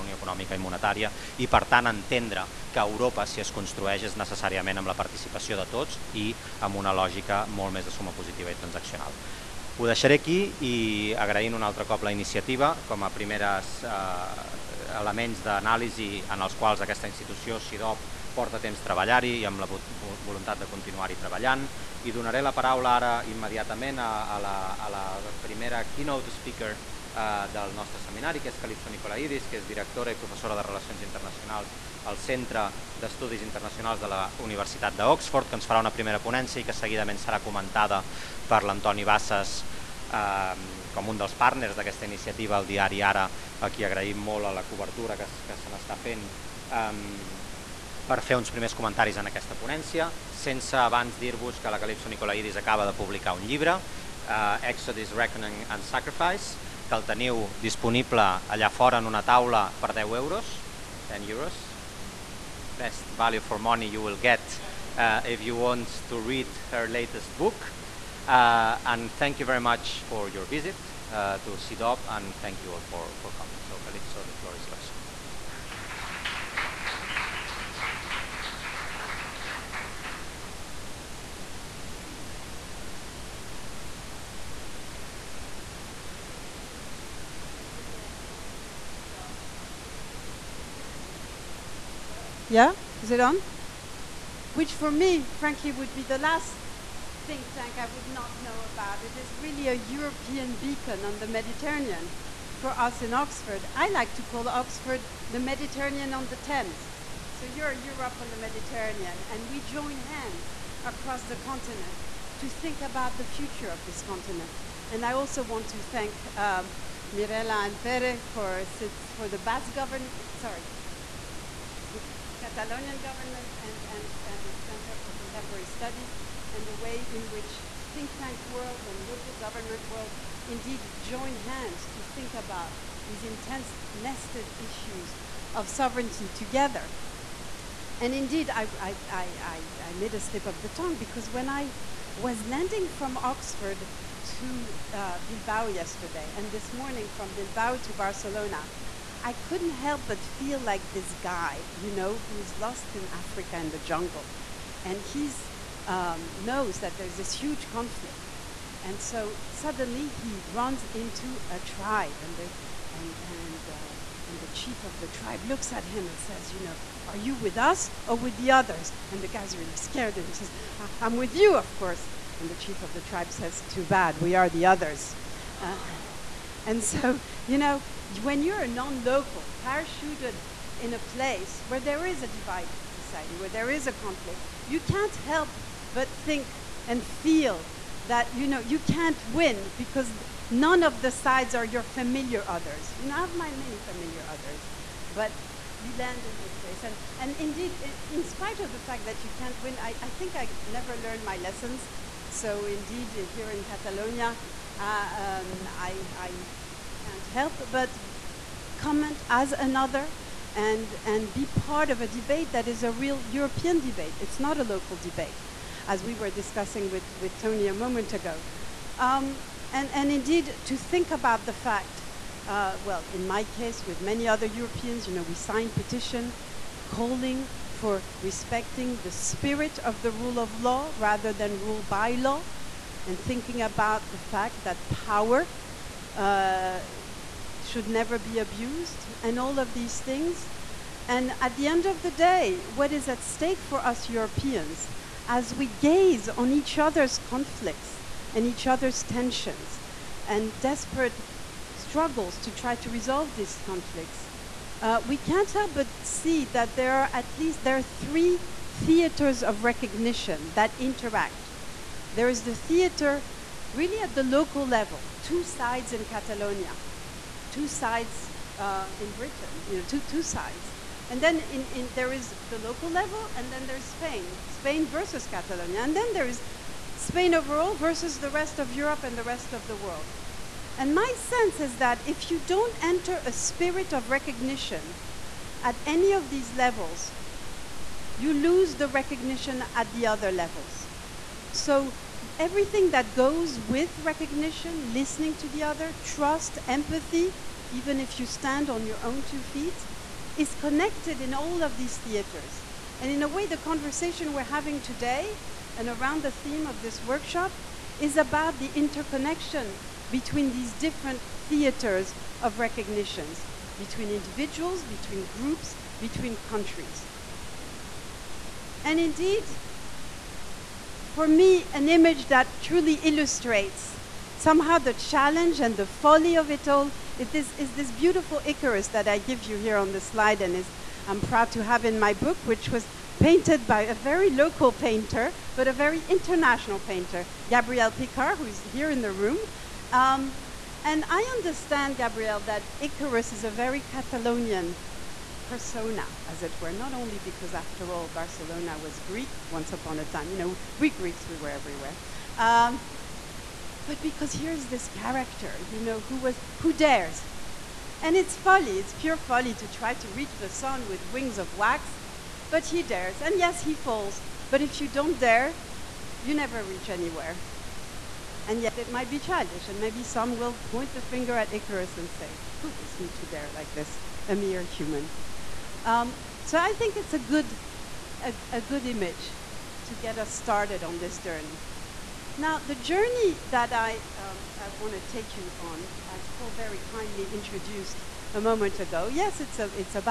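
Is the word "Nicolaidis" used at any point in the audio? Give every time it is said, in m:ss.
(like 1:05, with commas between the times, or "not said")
0:28, 0:52.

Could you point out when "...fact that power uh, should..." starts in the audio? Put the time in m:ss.
3:54.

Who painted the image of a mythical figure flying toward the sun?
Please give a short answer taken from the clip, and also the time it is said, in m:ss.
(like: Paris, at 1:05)
Gabrielle Picard, at 5:37.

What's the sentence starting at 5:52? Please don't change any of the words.
Um, but because here's this character, you know, who, was, who dares.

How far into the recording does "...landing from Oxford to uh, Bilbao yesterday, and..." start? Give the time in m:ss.
2:22.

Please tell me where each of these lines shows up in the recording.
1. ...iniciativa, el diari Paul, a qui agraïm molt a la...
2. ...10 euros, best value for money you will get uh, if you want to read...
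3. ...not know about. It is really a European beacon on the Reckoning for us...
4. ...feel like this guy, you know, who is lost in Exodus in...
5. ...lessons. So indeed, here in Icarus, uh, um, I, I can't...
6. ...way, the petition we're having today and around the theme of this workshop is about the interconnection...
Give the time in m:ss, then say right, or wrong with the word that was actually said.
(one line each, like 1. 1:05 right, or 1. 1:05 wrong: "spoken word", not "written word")
1. 0:42 wrong: "Ara", not "Paul"
2. 1:01 right
3. 1:38 wrong: "Mediterranean", not "Reckoning"
4. 2:30 wrong: "Africa", not "Exodus"
5. 3:21 wrong: "Catalonia", not "Icarus"
6. 5:03 wrong: "conversation", not "petition".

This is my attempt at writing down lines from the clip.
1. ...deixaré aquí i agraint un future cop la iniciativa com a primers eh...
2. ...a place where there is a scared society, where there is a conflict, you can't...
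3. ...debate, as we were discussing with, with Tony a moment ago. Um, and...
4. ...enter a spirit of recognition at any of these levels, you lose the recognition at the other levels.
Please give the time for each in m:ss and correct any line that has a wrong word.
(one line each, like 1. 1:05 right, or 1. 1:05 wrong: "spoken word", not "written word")
1. 0:09 wrong: "altre", not "future"
2. 3:00 wrong: "divided", not "scared"
3. 3:34 right
4. 4:42 right.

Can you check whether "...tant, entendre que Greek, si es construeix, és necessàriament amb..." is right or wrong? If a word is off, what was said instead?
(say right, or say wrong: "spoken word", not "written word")
wrong: "Europa", not "Greek".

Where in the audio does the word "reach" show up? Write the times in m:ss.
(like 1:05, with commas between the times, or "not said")
6:00, 6:06.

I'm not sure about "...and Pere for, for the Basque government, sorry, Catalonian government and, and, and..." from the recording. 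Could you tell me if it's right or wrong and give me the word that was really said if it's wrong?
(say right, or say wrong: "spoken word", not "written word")
right.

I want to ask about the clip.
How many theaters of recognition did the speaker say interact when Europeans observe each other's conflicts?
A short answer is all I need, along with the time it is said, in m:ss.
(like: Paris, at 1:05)
3, at 4:17.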